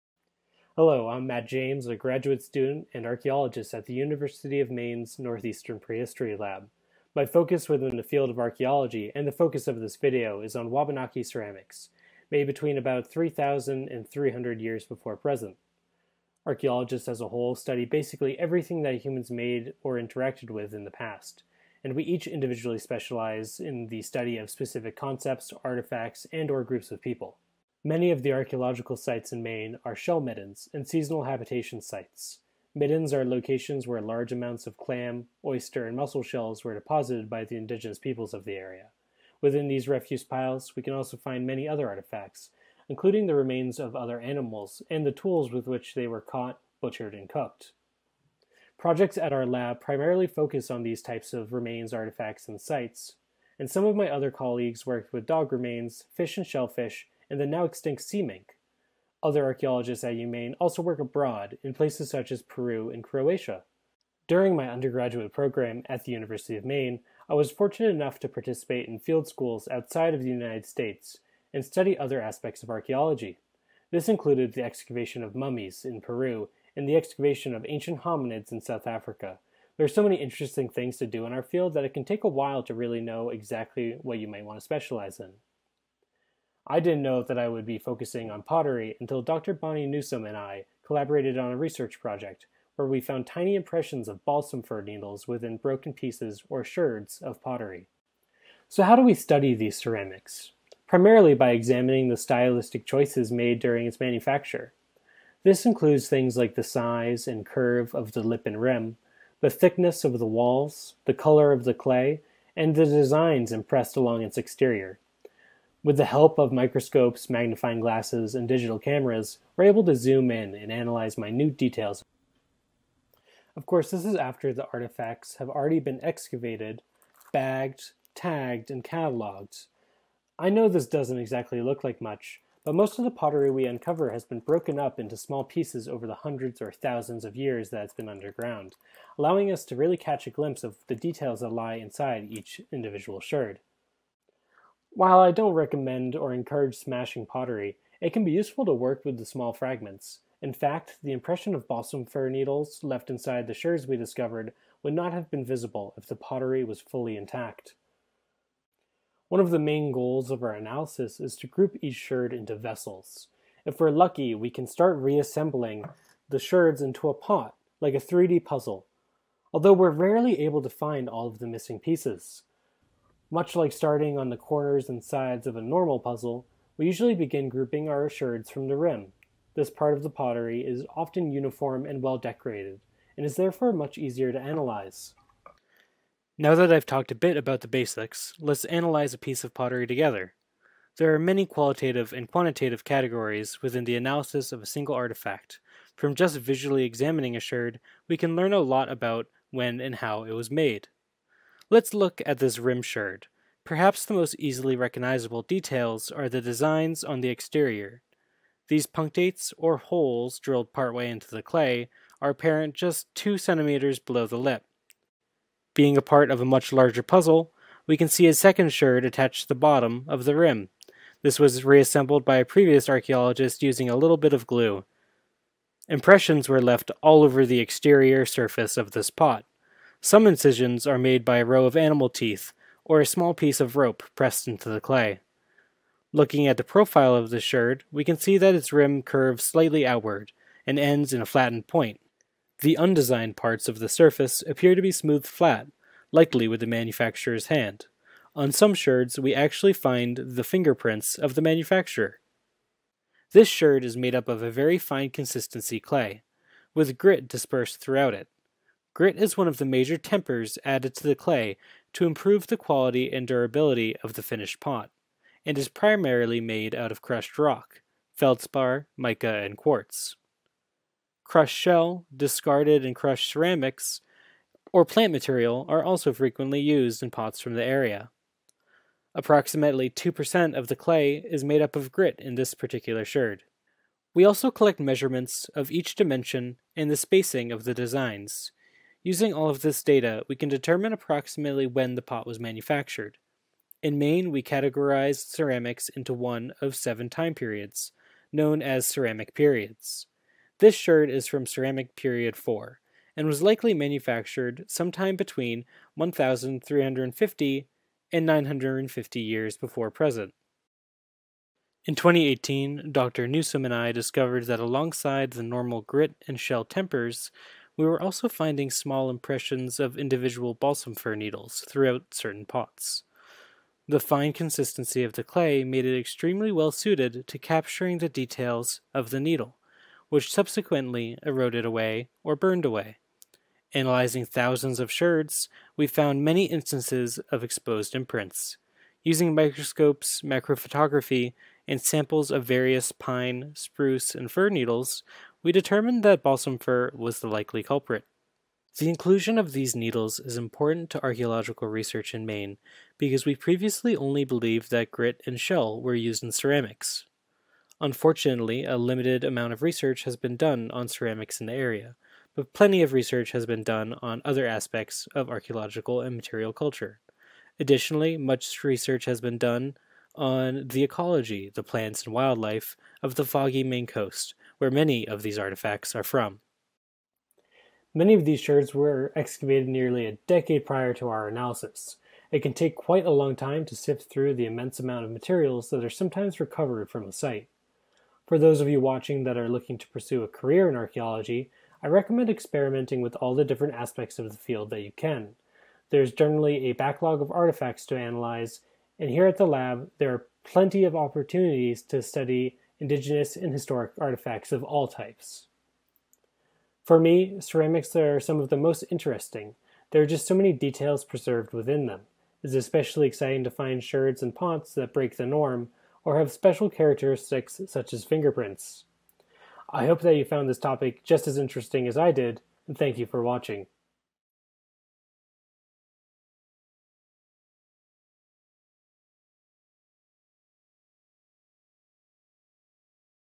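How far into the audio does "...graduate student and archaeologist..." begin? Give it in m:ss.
0:01.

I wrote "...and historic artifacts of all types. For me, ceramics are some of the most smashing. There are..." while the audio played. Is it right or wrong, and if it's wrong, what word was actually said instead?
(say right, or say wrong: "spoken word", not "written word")
wrong: "interesting", not "smashing".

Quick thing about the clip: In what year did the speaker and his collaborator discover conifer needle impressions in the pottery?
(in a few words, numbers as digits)
2018.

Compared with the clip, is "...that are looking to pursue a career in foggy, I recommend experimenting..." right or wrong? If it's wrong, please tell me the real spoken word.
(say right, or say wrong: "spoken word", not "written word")
wrong: "archaeology", not "foggy".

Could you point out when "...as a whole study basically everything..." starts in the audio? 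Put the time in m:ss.
0:17.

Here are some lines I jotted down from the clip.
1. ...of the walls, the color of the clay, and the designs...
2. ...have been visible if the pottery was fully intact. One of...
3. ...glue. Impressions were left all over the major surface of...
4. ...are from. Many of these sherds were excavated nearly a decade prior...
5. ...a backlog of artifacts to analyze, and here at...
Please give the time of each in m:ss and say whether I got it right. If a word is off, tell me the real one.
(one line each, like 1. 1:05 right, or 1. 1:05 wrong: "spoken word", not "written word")
1. 1:50 right
2. 2:35 right
3. 3:44 wrong: "exterior", not "major"
4. 6:15 right
5. 6:36 right.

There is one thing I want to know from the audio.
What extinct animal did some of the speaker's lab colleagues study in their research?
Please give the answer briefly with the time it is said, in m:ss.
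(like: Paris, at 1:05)
sea mink, at 0:58.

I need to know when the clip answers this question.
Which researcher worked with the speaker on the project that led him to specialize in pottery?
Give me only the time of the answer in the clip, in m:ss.
1:29.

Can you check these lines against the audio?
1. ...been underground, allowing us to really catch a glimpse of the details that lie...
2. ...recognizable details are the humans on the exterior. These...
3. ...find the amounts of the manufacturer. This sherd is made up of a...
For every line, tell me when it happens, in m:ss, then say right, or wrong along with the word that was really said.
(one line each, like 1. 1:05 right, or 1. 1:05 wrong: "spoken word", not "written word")
1. 2:17 right
2. 3:24 wrong: "designs", not "humans"
3. 4:09 wrong: "fingerprints", not "amounts".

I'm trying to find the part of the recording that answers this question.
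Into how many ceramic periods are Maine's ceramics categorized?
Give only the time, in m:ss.
4:56.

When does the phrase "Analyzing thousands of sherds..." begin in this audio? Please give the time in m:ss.
5:33.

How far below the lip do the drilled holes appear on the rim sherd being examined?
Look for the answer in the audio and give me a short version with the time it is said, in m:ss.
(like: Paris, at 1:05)
2 centimeters, at 3:33.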